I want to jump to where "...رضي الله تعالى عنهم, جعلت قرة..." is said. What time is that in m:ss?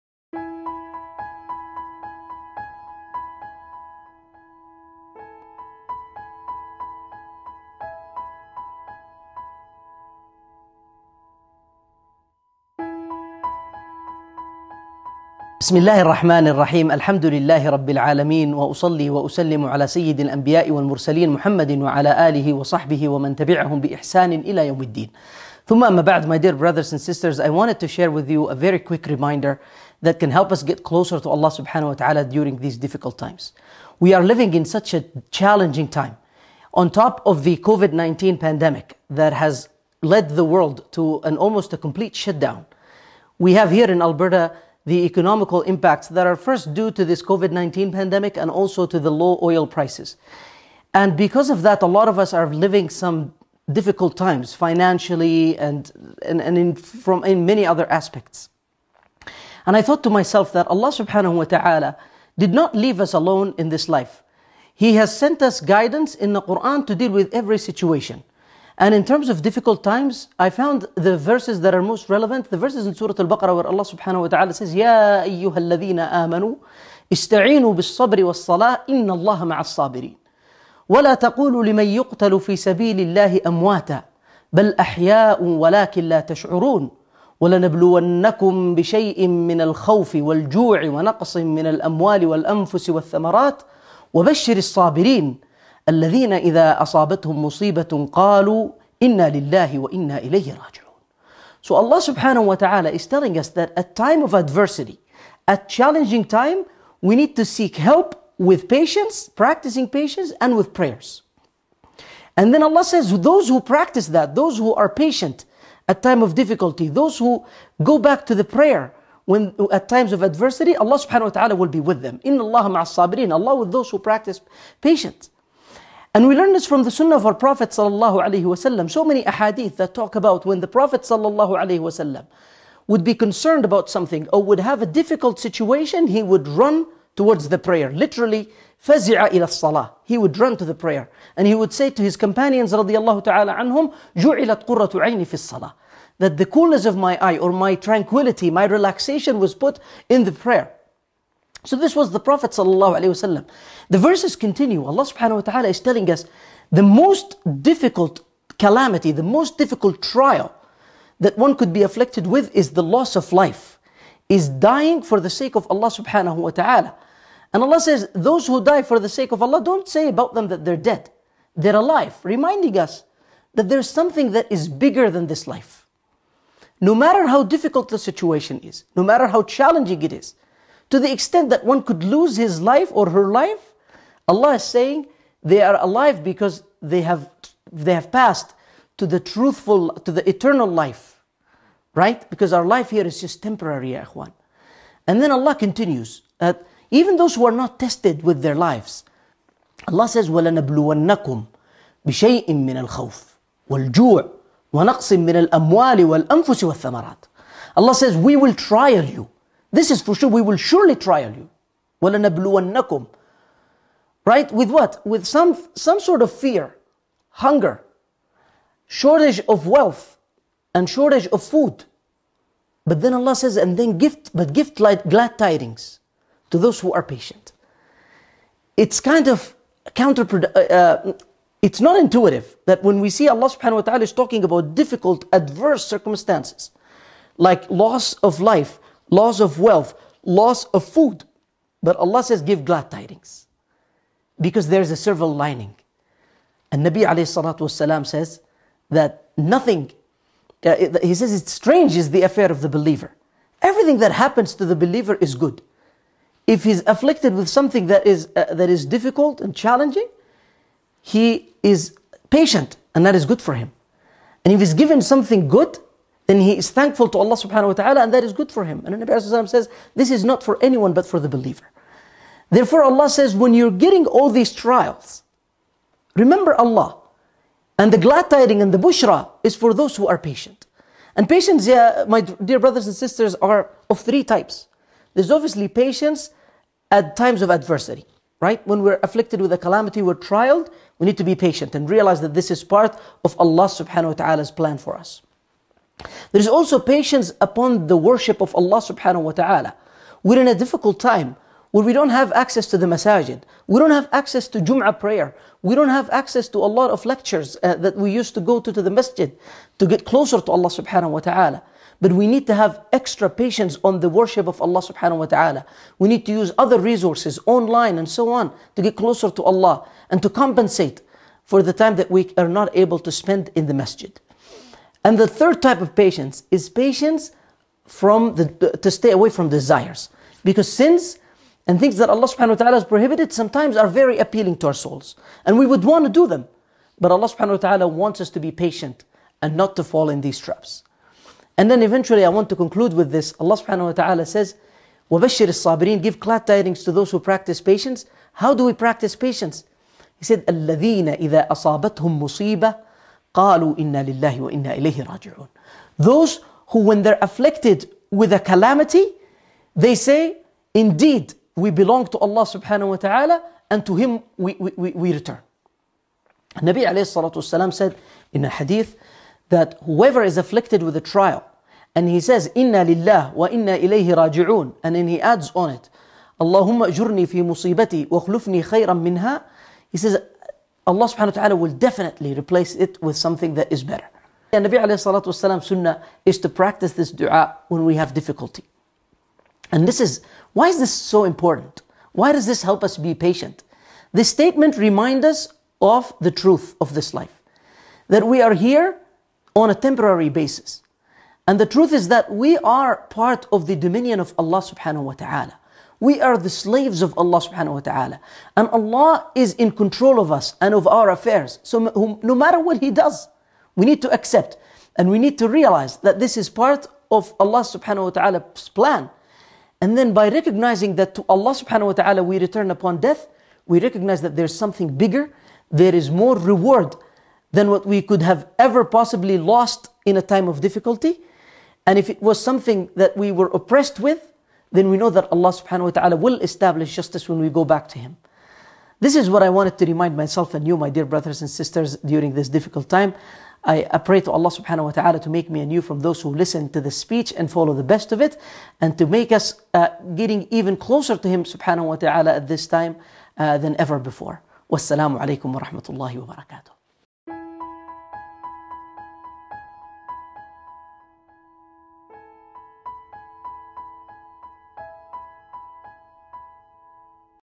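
2:22.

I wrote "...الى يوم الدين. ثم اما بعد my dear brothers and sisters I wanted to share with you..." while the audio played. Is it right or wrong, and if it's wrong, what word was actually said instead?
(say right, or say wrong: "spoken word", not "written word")
right.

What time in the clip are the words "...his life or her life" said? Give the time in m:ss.
3:02.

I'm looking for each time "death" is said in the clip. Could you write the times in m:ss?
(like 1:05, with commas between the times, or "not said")
7:02.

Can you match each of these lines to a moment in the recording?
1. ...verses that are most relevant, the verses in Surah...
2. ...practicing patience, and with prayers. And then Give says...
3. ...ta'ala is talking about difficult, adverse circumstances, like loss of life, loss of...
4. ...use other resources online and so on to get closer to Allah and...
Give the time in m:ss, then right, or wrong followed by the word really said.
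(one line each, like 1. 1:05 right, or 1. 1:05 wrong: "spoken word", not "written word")
1. 1:11 right
2. 1:49 wrong: "Allah", not "Give"
3. 3:53 right
4. 5:16 right.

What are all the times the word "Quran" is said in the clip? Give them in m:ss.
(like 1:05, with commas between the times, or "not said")
1:06.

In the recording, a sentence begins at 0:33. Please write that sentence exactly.
We are living in such a challenging time.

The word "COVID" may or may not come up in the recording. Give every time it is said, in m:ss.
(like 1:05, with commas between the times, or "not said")
0:37, 0:47.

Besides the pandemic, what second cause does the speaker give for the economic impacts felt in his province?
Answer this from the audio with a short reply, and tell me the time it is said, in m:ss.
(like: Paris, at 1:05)
Low oil prices, at 0:49.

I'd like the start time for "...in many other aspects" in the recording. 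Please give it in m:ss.
0:57.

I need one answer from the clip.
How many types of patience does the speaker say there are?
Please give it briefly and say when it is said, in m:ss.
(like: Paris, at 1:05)
3, at 4:43.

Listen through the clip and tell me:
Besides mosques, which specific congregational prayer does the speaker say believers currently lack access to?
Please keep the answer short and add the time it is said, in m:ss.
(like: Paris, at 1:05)
Jum'ah prayer, at 5:04.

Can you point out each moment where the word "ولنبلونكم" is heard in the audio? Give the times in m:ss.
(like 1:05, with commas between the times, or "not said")
1:27, 3:20, 3:32.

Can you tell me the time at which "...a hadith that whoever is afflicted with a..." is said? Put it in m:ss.
6:08.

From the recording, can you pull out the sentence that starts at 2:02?
In Allah sabirin, Allah with those who practice patience.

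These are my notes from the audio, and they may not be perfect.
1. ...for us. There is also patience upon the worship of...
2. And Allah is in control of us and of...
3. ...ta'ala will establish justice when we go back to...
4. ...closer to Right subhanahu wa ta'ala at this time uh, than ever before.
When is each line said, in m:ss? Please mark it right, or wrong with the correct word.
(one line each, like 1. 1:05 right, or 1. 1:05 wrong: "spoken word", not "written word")
1. 4:54 right
2. 6:48 right
3. 7:15 right
4. 7:30 wrong: "Him", not "Right".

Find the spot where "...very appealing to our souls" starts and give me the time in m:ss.
5:33.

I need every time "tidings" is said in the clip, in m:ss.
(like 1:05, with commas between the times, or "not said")
3:45, 4:02, 4:38, 5:46.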